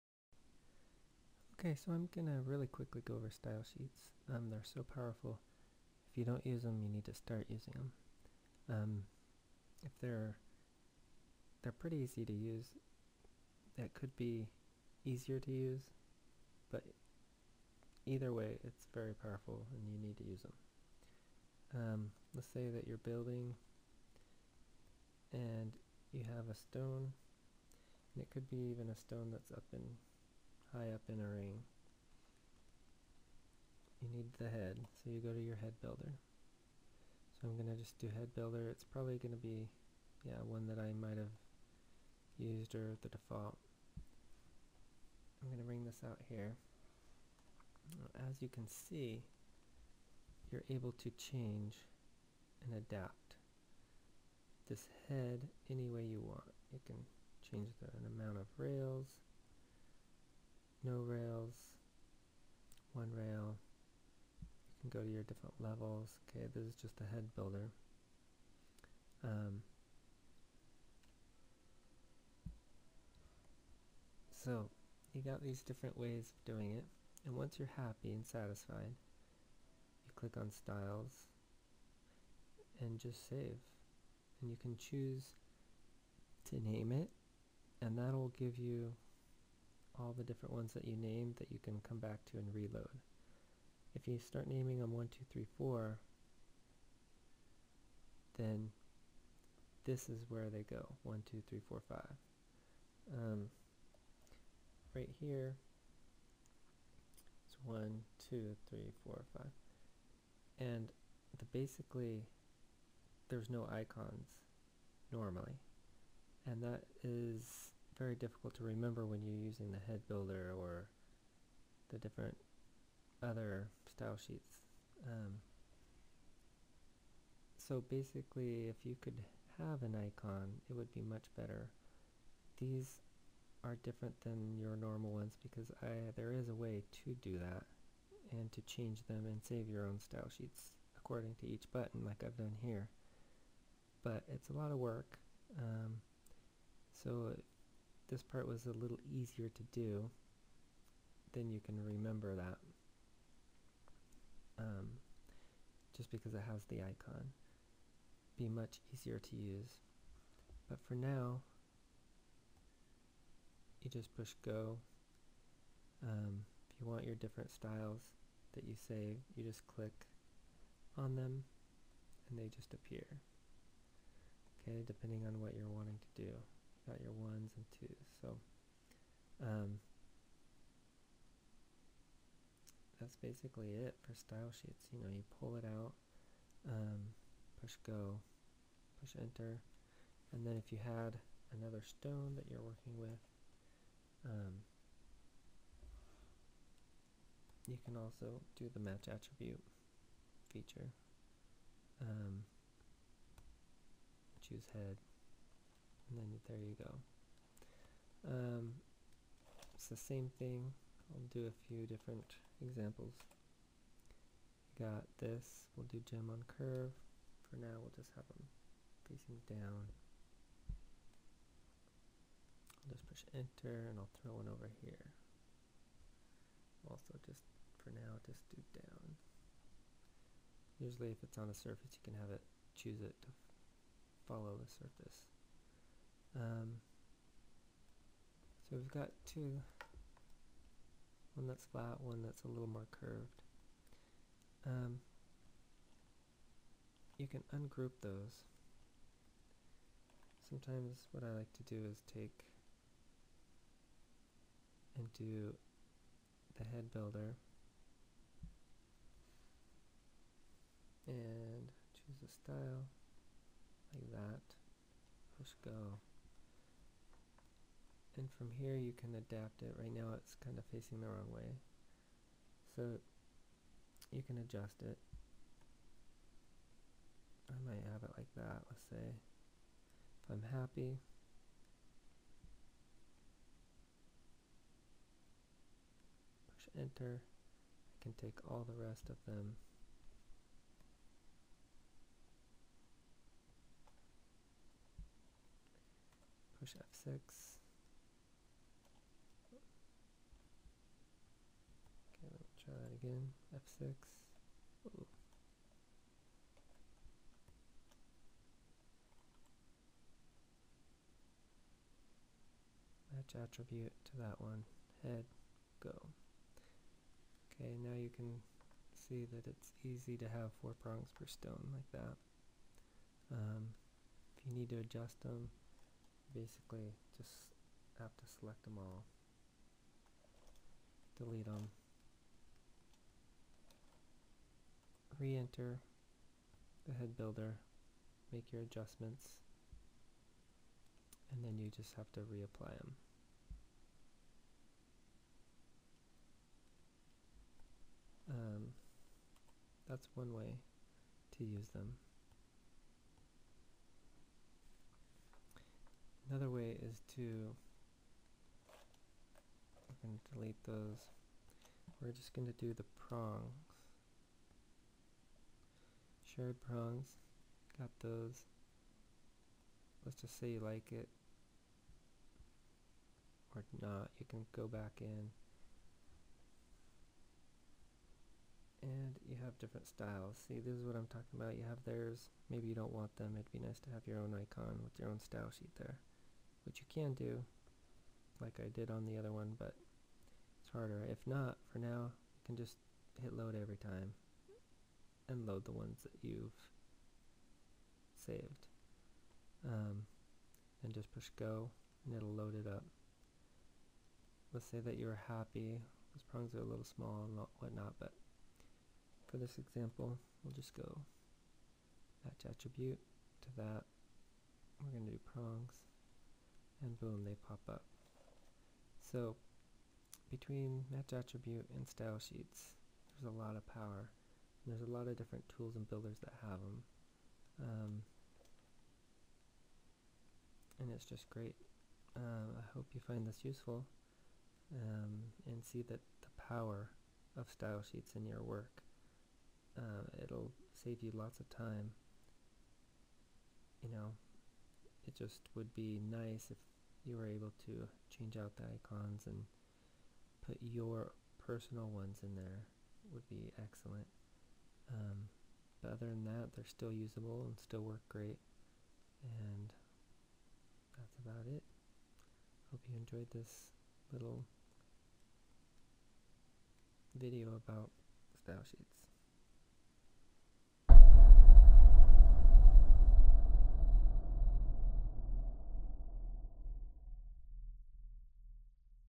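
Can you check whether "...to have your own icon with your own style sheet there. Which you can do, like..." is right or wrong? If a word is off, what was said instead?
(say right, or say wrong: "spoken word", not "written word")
right.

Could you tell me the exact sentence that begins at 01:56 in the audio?
And that is very difficult to remember when you're using the head builder or the different other style sheets.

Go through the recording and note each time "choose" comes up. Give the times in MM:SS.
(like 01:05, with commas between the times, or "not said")
01:24, 03:24, 03:52, 04:21.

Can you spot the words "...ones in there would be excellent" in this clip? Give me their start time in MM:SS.
07:31.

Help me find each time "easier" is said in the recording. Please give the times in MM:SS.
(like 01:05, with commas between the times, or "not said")
00:15, 02:29, 02:38.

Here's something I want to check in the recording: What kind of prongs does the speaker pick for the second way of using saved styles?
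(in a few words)
Cherry prongs.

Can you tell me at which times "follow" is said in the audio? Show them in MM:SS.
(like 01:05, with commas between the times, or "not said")
03:54.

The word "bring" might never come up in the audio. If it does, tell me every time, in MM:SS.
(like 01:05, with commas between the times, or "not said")
00:45.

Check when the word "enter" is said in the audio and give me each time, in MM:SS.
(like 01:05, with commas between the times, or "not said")
03:09, 03:43, 04:46, 05:35.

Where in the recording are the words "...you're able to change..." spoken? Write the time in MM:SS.
00:50.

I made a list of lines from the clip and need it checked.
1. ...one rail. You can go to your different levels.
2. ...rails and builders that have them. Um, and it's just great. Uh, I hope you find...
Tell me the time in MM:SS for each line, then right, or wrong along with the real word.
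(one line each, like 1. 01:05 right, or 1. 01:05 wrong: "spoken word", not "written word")
1. 01:02 right
2. 07:05 wrong: "tools", not "rails".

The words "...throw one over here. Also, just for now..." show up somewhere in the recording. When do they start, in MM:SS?
03:44.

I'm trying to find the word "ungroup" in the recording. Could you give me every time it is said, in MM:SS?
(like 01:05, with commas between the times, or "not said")
04:07.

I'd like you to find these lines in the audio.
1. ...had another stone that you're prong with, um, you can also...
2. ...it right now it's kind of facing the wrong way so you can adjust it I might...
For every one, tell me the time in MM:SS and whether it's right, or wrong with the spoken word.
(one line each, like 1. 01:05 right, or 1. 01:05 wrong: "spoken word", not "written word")
1. 03:10 wrong: "working", not "prong"
2. 04:29 right.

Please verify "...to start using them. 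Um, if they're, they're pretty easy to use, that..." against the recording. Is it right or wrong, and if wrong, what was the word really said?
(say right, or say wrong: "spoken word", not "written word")
right.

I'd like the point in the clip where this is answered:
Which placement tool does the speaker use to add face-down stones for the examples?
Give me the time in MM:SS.
03:36.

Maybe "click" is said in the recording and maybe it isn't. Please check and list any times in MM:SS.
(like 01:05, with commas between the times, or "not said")
01:20, 02:49.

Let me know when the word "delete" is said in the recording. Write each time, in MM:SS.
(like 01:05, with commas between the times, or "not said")
05:31, 06:00.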